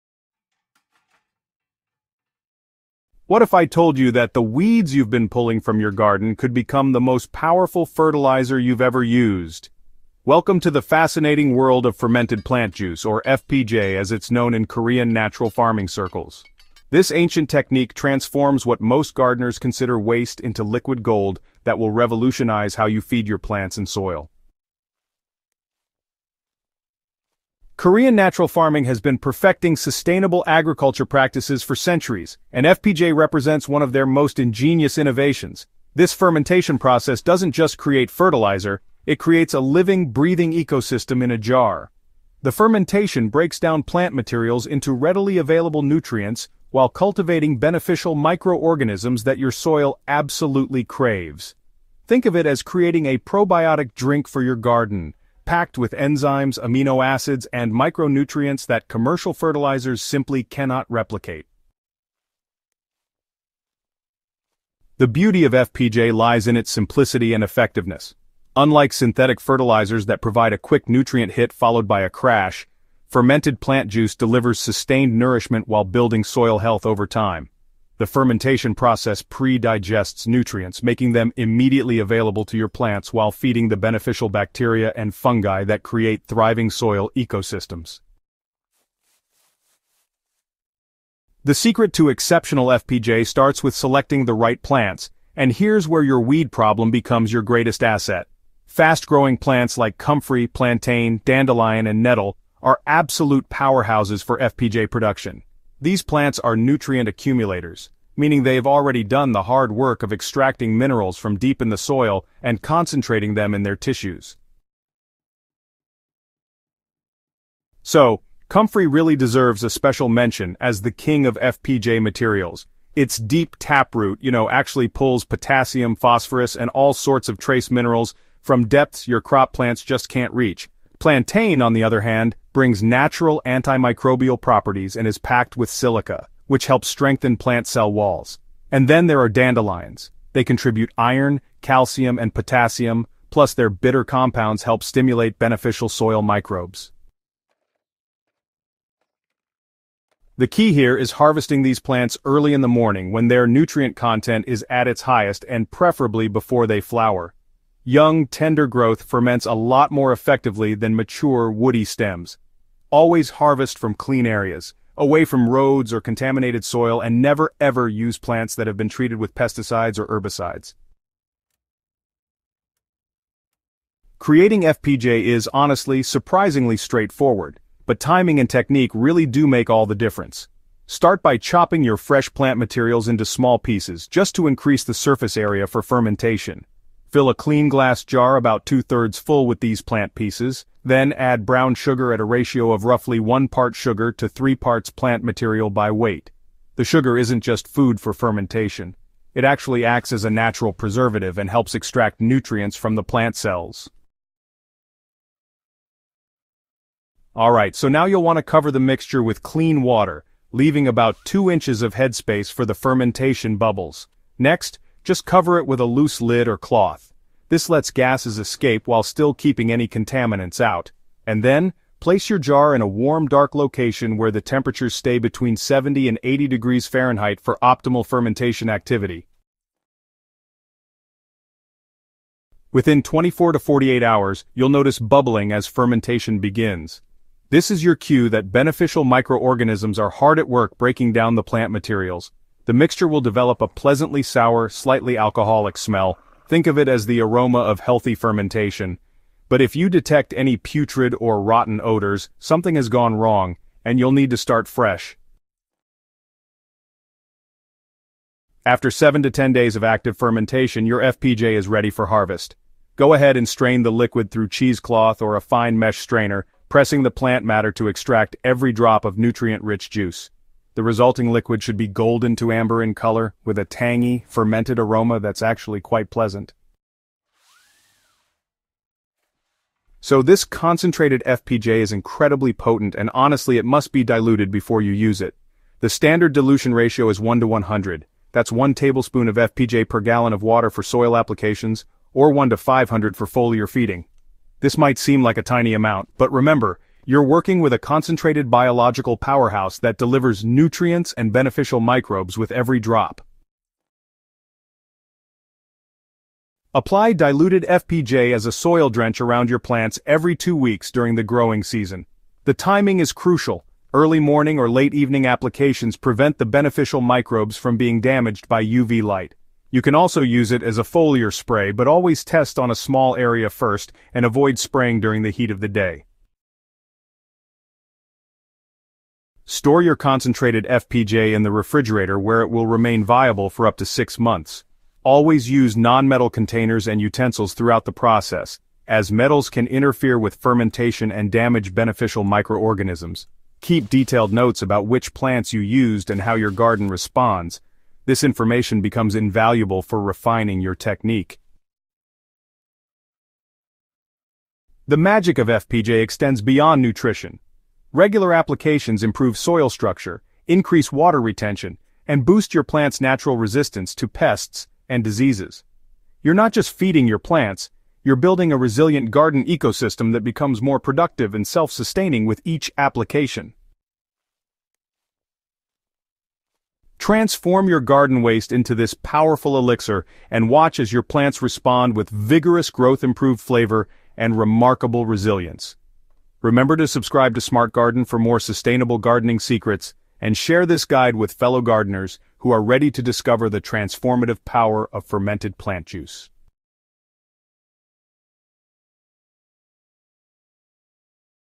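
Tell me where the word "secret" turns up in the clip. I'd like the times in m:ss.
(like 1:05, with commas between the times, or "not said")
1:31, 6:29.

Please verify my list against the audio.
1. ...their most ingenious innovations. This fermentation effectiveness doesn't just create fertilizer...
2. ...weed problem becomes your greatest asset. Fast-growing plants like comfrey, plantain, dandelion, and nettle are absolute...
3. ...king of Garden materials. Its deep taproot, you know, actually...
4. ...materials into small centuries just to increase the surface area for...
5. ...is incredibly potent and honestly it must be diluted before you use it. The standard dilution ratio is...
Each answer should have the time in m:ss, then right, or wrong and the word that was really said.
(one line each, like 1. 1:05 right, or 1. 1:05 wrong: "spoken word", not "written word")
1. 0:33 wrong: "process", not "effectiveness"
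2. 1:36 right
3. 2:00 wrong: "FPJ", not "Garden"
4. 3:02 wrong: "pieces", not "centuries"
5. 4:41 right.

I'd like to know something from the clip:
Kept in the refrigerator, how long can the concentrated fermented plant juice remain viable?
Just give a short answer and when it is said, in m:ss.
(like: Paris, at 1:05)
6 months, at 5:33.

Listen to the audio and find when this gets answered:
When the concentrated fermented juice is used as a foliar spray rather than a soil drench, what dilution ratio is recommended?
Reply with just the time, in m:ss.
4:52.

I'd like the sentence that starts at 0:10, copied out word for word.
Welcome to the fascinating world of fermented plant juice, or FPJ as it's known in Korean natural farming circles.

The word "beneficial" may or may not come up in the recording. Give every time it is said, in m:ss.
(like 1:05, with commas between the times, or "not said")
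0:47, 1:23, 2:25, 3:58, 5:01, 5:16, 5:41.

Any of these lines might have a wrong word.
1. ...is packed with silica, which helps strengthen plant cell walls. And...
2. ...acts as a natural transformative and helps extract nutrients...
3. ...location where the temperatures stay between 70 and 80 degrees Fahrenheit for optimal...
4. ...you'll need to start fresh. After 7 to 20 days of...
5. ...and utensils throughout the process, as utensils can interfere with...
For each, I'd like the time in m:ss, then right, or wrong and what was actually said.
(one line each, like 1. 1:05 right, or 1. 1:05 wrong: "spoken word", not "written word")
1. 2:15 right
2. 3:19 wrong: "preservative", not "transformative"
3. 3:43 right
4. 4:13 wrong: "10", not "20"
5. 5:36 wrong: "metals", not "utensils".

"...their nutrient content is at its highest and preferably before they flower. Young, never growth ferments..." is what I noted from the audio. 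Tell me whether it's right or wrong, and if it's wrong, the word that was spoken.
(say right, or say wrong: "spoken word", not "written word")
wrong: "tender", not "never".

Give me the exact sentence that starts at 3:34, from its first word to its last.
Next, just cover it with a loose lid or cloth.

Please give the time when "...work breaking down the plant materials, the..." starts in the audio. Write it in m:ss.
4:00.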